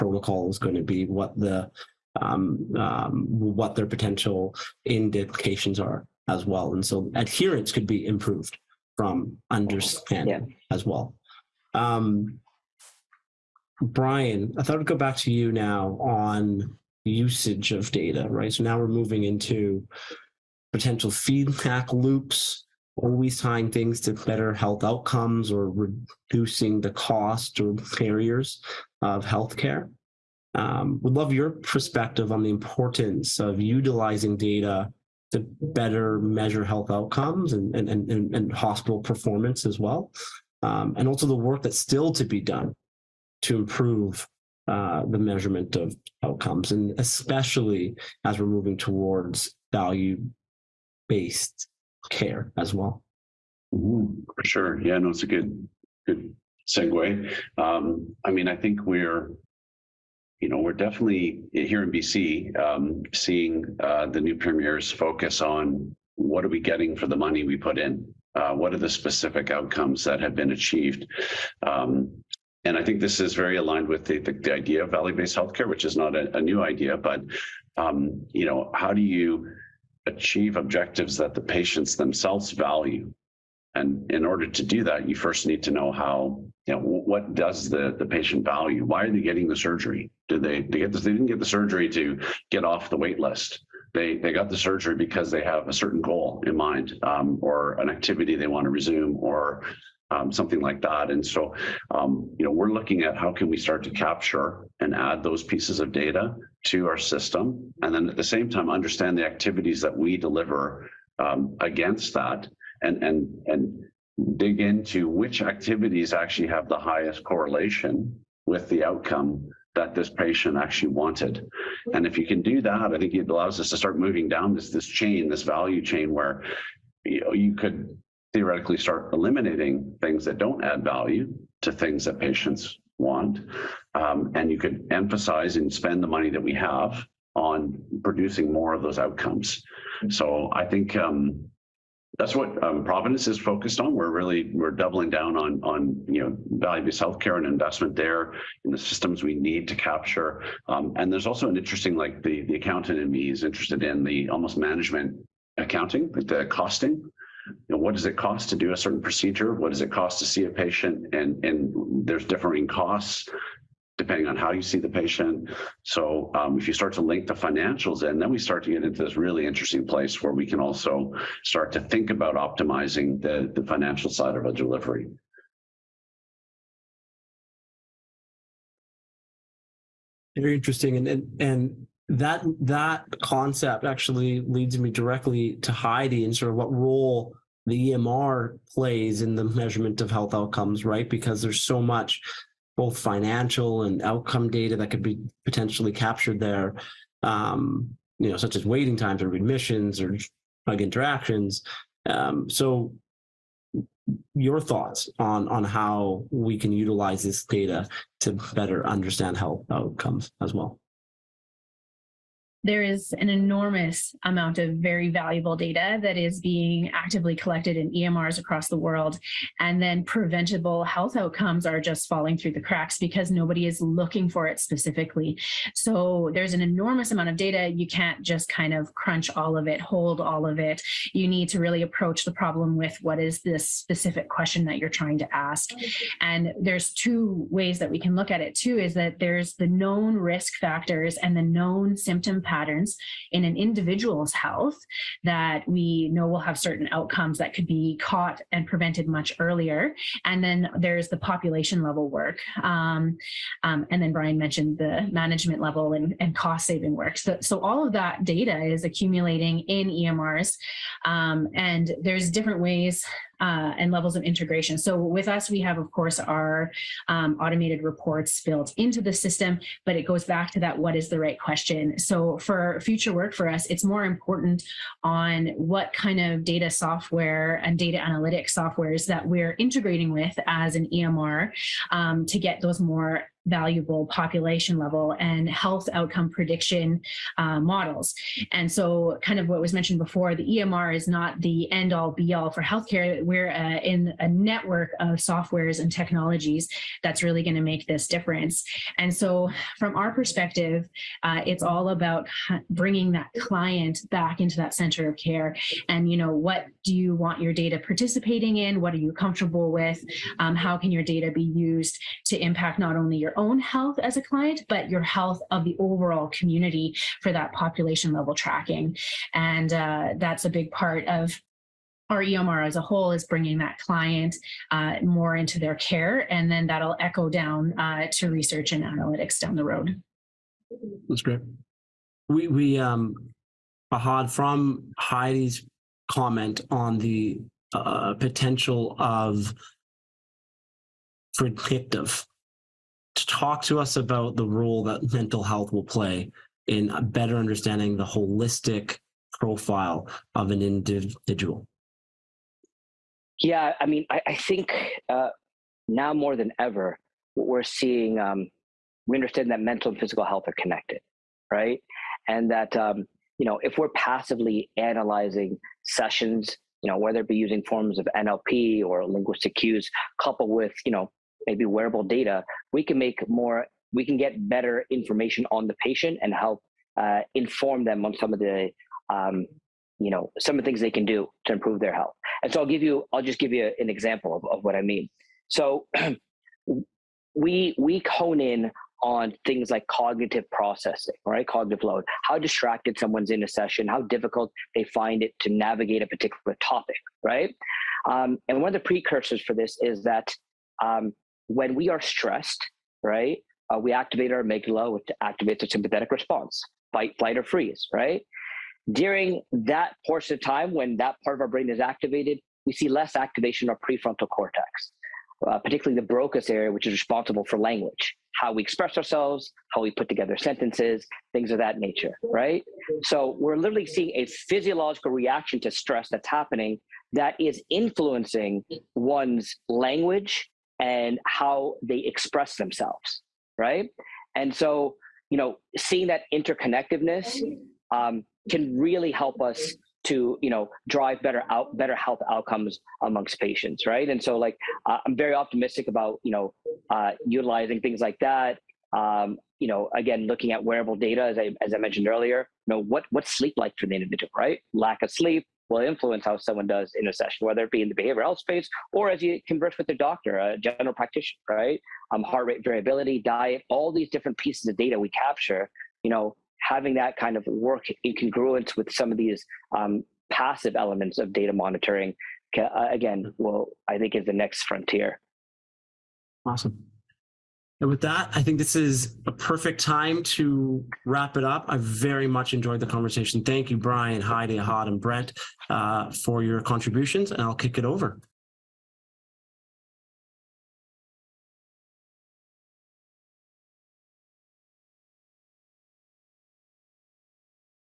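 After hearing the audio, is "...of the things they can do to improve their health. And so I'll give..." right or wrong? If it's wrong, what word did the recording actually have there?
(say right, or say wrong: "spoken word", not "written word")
right.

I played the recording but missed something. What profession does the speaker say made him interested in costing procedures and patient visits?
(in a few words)
accountant.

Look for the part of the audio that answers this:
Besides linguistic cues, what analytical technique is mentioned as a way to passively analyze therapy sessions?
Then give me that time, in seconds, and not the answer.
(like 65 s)
368 s.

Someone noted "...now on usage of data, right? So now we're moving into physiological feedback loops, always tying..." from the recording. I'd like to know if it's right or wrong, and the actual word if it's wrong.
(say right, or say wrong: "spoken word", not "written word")
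wrong: "potential", not "physiological".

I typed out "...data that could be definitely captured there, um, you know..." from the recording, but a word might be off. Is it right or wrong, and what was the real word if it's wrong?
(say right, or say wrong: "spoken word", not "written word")
wrong: "potentially", not "definitely".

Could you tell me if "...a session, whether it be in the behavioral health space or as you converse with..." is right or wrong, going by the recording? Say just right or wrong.
right.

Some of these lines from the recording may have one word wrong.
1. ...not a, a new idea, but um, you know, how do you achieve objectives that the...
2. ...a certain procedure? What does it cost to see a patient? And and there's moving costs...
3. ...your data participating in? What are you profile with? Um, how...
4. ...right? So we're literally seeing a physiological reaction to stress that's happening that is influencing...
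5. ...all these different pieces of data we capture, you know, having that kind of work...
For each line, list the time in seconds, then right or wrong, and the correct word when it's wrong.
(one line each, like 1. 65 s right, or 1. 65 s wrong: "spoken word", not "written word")
1. 75 s right
2. 158 s wrong: "differing", not "moving"
3. 307 s wrong: "comfortable", not "profile"
4. 422 s right
5. 463 s right.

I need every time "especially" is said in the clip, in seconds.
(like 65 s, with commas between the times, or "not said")
46 s.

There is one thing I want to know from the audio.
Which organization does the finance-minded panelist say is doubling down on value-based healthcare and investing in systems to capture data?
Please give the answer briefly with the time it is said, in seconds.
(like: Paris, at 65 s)
Providence, at 142 s.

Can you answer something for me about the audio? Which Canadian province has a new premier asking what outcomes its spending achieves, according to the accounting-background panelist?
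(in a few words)
BC.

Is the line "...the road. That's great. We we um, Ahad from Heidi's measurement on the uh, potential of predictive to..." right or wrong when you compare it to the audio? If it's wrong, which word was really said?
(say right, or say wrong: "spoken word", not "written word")
wrong: "comment", not "measurement".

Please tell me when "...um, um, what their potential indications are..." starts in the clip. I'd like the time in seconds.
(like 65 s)
2 s.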